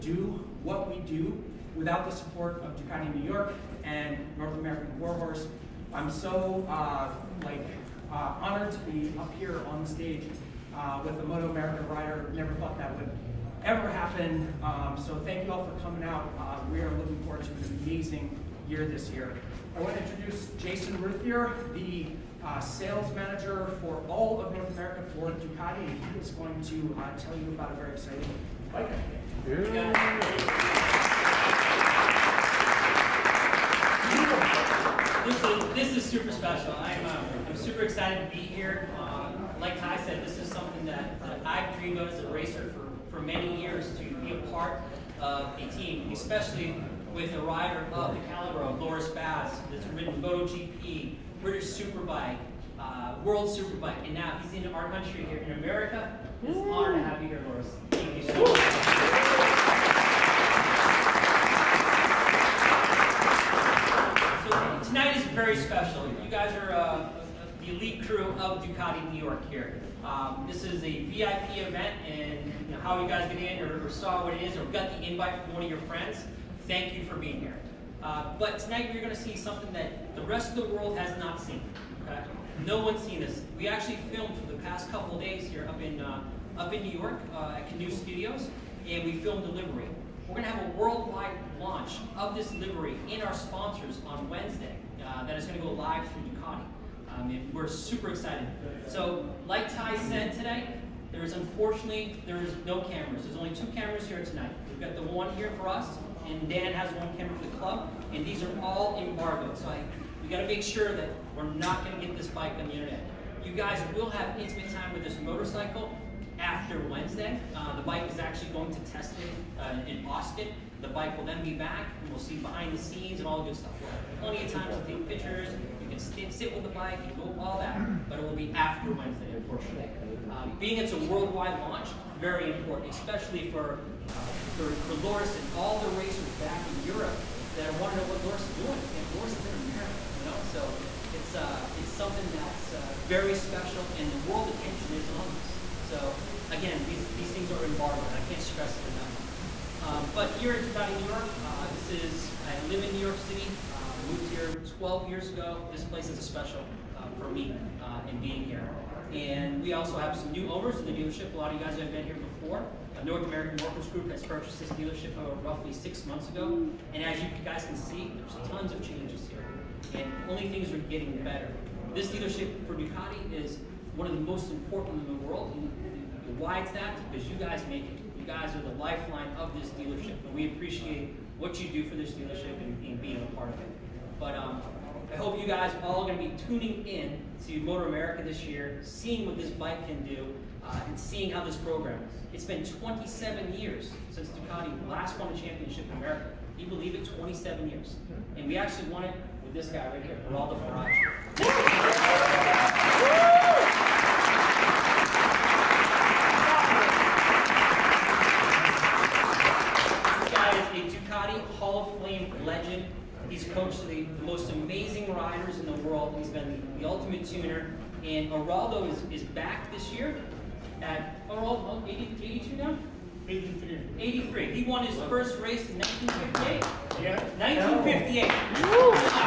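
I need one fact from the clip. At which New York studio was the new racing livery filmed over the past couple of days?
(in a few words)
Canoe Studios.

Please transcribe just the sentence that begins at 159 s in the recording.
And we also have some new owners in the dealership.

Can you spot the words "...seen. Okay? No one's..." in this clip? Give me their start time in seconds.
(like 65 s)
81 s.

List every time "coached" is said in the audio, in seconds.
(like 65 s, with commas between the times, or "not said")
213 s.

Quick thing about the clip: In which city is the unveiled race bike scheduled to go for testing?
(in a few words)
Austin.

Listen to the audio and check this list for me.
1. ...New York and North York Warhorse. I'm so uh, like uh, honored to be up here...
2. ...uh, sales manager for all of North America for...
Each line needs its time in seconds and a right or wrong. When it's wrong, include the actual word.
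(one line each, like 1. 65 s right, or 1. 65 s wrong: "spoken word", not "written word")
1. 3 s wrong: "American", not "York"
2. 22 s right.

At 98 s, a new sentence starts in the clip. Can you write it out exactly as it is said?
So, like Ty said today, there is unfortunately there is no cameras.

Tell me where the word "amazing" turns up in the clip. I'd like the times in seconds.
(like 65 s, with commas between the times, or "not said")
17 s, 214 s.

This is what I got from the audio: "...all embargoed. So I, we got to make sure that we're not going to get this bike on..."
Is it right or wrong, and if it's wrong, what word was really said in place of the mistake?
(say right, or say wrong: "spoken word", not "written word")
right.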